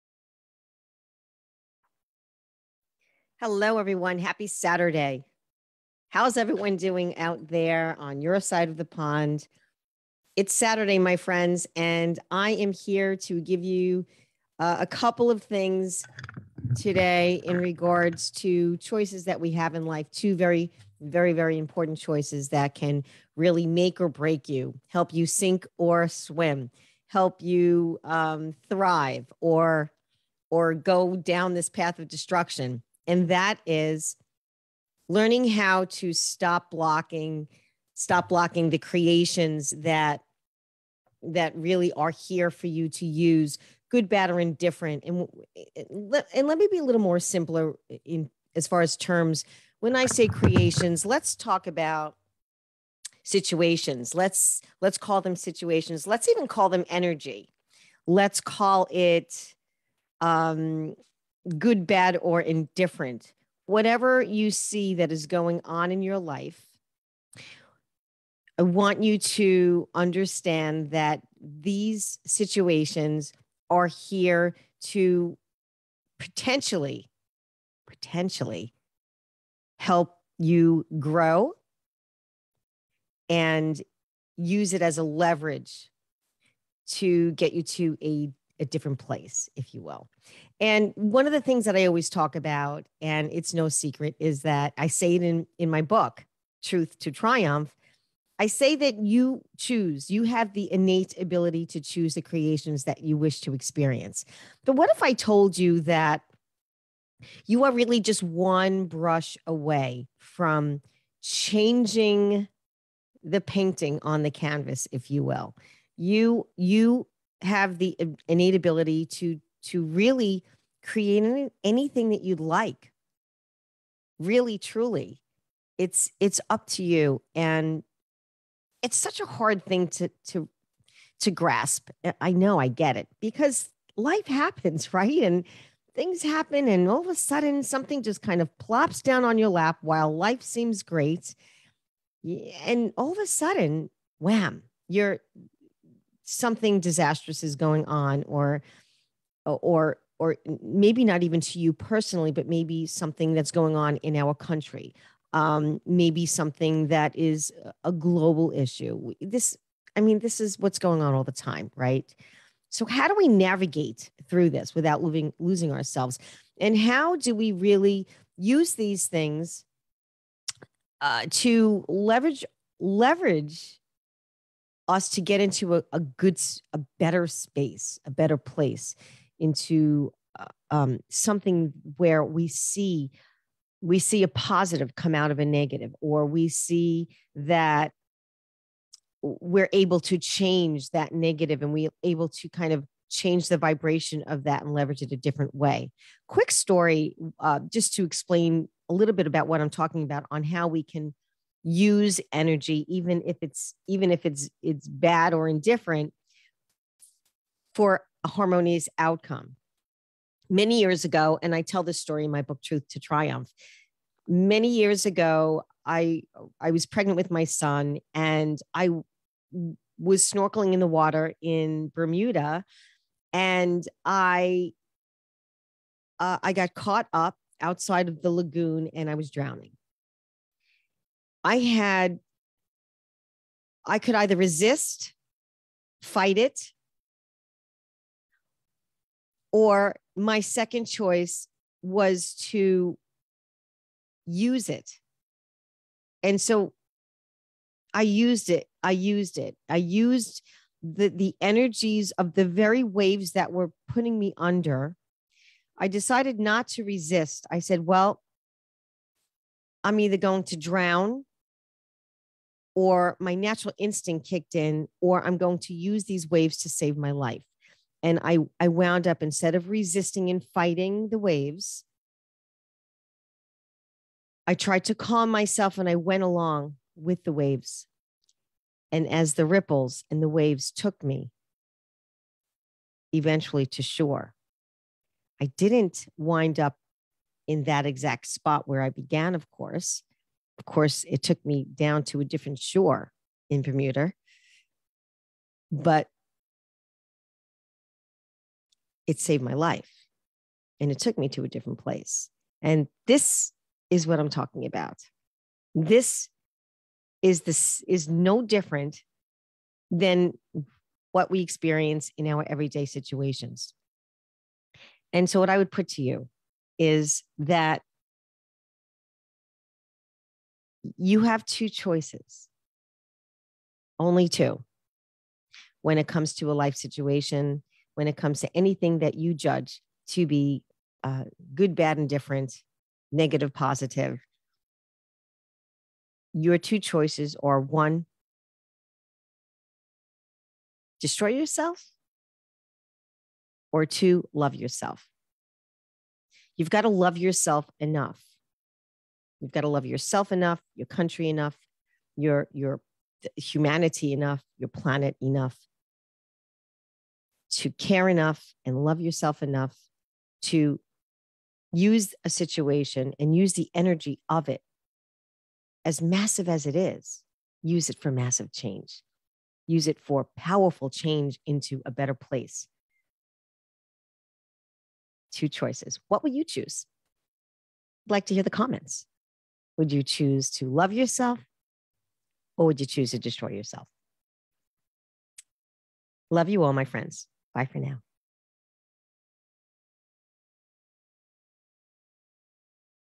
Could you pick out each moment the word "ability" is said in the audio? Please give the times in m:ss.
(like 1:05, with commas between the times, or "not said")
1:41, 1:58.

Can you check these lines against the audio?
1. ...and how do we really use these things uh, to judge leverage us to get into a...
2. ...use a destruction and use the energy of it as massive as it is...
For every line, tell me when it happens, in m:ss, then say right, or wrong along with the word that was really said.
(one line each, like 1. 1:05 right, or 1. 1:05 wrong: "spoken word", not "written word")
1. 2:46 wrong: "leverage", not "judge"
2. 6:01 wrong: "situation", not "destruction".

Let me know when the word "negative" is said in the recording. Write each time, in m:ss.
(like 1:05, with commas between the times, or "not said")
3:05, 3:11, 5:33.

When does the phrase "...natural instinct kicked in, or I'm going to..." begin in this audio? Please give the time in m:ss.
4:23.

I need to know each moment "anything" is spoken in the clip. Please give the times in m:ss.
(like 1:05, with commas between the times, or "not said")
2:01, 5:28.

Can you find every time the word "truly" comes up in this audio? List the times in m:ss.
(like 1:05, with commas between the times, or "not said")
2:04.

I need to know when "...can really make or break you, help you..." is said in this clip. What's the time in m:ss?
0:22.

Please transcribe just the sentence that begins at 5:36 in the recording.
Your two choices are one, destroy yourself, or two, love yourself.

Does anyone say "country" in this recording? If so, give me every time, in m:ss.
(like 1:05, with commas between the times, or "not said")
2:34, 5:50.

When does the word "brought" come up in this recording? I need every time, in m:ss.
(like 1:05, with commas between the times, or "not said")
not said.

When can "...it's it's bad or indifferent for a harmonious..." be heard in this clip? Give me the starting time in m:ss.
3:24.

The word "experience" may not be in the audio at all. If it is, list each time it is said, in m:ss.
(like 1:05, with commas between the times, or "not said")
1:43, 5:11.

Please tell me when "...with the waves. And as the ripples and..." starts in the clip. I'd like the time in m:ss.
4:36.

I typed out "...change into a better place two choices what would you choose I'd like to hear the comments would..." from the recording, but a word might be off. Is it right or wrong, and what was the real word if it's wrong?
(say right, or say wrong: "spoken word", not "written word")
right.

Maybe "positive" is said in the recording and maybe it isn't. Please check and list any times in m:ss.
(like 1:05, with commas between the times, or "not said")
3:04, 5:33.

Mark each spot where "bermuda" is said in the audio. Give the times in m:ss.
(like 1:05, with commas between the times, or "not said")
3:41, 4:53.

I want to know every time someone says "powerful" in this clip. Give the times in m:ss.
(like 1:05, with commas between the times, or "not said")
6:10.